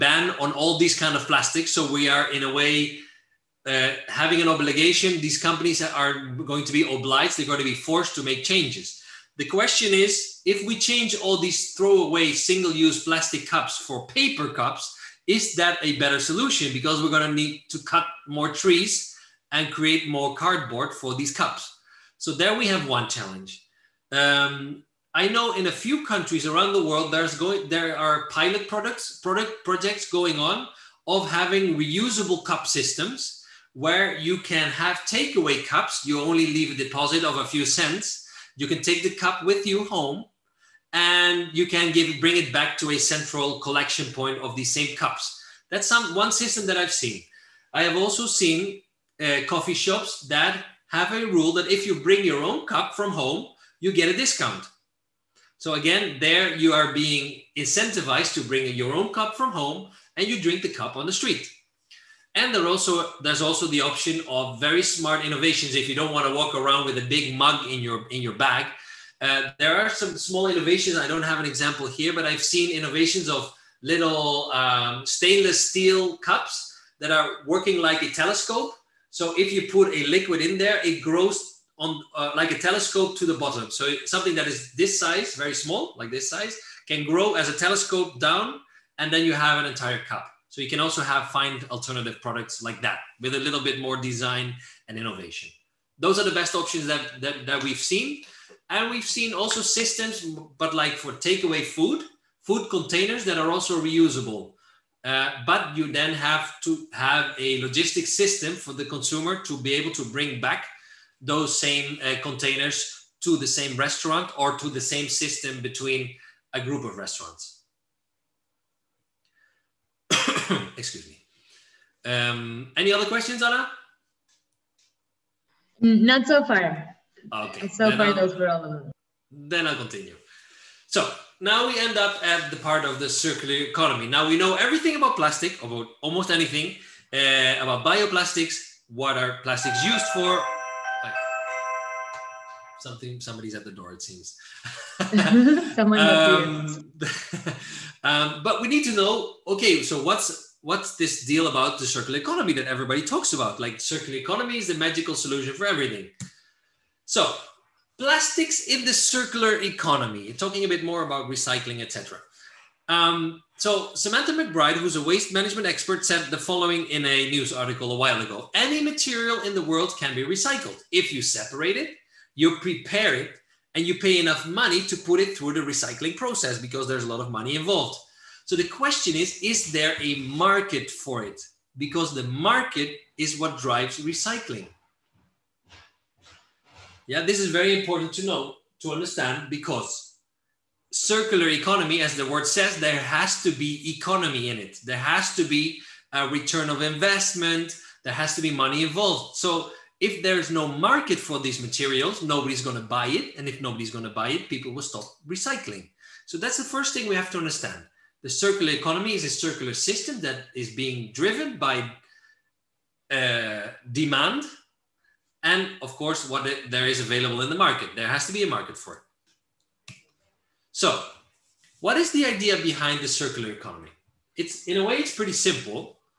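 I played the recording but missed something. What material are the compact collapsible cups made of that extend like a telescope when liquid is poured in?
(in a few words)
stainless steel.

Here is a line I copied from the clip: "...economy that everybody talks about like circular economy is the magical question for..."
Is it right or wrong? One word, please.
wrong.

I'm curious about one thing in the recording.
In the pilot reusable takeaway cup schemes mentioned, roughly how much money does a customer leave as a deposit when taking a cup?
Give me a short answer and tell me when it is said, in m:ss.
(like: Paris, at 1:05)
a few cents, at 0:37.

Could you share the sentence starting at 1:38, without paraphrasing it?
And we've seen also systems, but like for takeaway food, food containers that are also reusable.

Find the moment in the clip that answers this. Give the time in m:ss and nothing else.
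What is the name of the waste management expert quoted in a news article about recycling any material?
2:43.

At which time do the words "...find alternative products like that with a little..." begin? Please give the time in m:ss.
1:31.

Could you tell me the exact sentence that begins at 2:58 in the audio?
So the question is is there a market for it?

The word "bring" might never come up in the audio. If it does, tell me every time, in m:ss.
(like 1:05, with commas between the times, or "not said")
0:42, 0:51, 0:58, 1:50.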